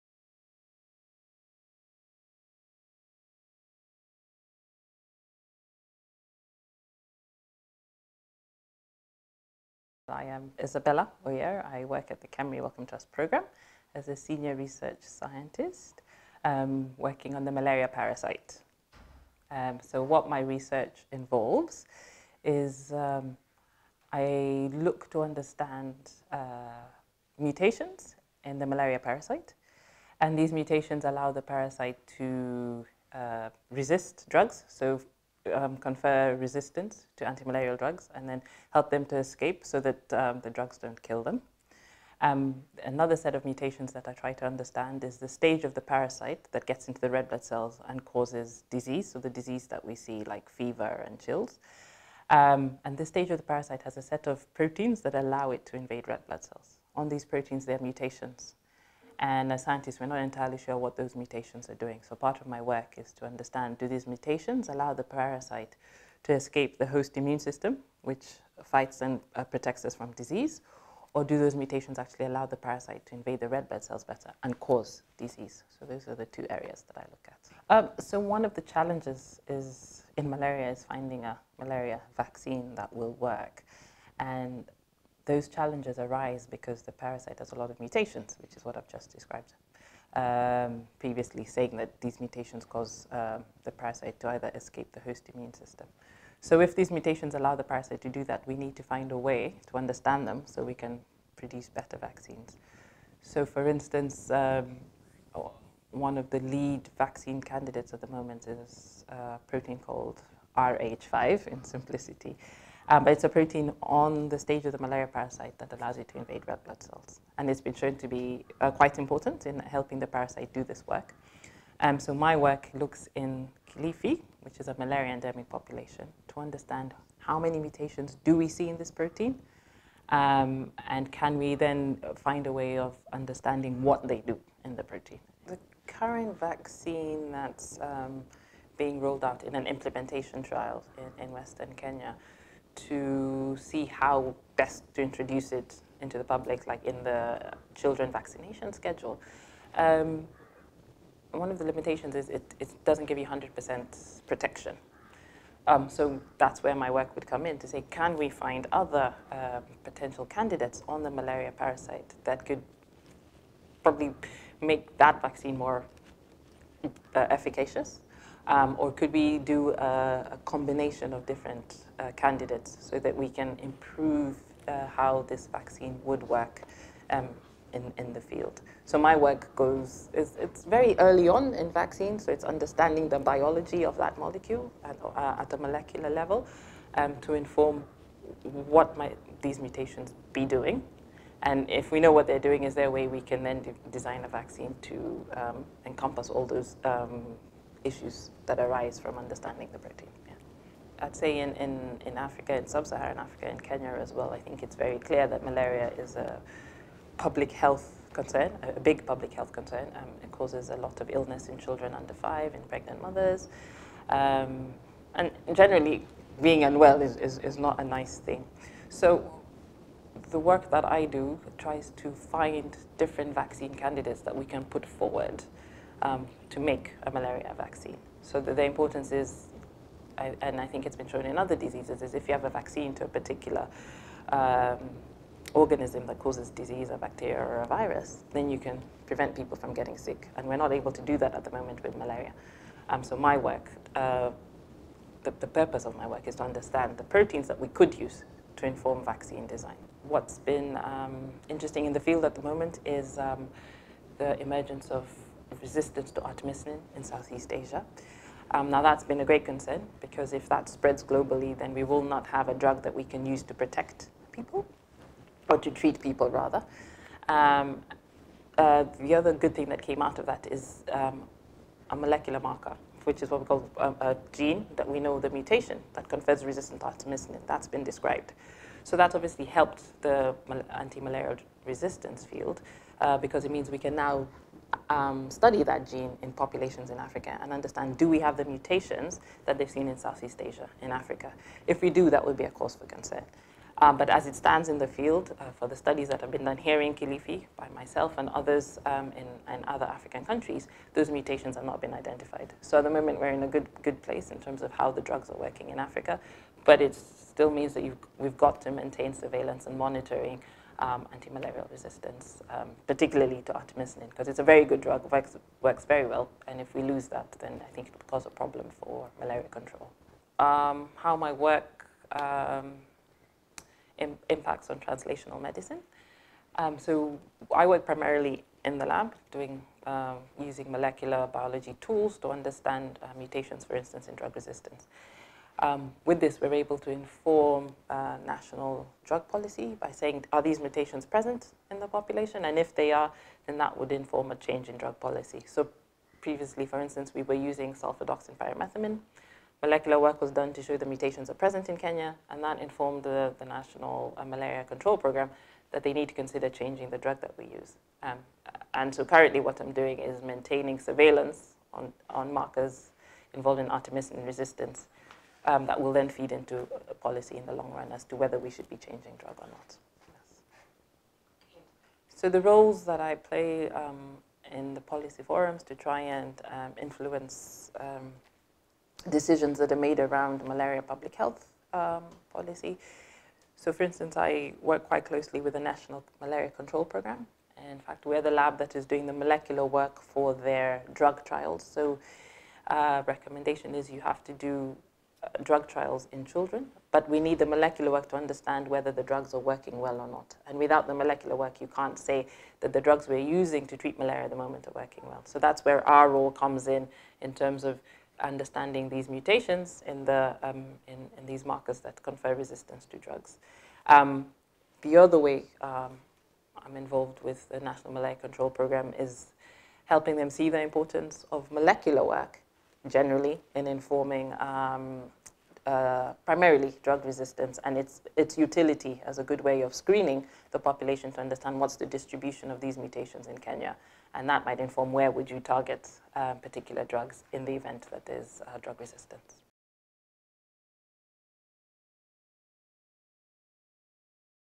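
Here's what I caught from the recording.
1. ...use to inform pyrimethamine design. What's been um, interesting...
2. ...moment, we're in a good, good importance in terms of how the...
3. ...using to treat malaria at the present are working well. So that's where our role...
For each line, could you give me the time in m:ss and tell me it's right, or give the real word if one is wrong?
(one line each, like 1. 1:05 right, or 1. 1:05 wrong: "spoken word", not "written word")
1. 4:07 wrong: "vaccine", not "pyrimethamine"
2. 5:02 wrong: "place", not "importance"
3. 6:43 wrong: "moment", not "present".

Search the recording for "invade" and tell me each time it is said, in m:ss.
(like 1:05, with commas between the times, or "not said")
0:55, 1:13, 1:56.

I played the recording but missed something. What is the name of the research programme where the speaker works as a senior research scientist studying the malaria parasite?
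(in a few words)
KEMRI Wellcome Trust Programme.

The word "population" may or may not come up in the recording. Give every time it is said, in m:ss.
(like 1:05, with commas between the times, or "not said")
2:05, 4:46, 5:41, 7:10.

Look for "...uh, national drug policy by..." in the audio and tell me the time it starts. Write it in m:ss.
5:37.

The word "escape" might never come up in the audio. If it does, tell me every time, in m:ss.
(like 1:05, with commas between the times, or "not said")
0:39, 1:06, 1:34.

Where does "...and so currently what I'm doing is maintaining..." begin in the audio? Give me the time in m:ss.
5:58.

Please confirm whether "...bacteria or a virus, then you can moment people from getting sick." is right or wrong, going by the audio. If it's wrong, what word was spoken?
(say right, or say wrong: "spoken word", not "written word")
wrong: "prevent", not "moment".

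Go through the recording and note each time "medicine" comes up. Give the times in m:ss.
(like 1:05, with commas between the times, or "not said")
5:25.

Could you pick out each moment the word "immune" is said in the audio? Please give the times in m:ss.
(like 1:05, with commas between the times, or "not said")
1:07, 1:35.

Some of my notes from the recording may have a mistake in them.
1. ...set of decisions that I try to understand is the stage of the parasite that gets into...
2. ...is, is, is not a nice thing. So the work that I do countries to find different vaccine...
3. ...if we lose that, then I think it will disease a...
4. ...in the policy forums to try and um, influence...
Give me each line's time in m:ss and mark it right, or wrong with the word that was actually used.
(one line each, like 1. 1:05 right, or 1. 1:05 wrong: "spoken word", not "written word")
1. 0:43 wrong: "mutations", not "decisions"
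2. 3:37 wrong: "tries", not "countries"
3. 5:16 wrong: "cause", not "disease"
4. 6:14 right.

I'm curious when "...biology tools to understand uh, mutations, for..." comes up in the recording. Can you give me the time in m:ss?
5:31.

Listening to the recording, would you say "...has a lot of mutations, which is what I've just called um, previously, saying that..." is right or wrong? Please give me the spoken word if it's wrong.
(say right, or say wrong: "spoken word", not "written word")
wrong: "described", not "called".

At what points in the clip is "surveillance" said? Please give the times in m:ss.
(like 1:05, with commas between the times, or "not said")
5:09, 6:00.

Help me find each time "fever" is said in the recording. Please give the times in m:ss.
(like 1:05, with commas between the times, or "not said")
0:50.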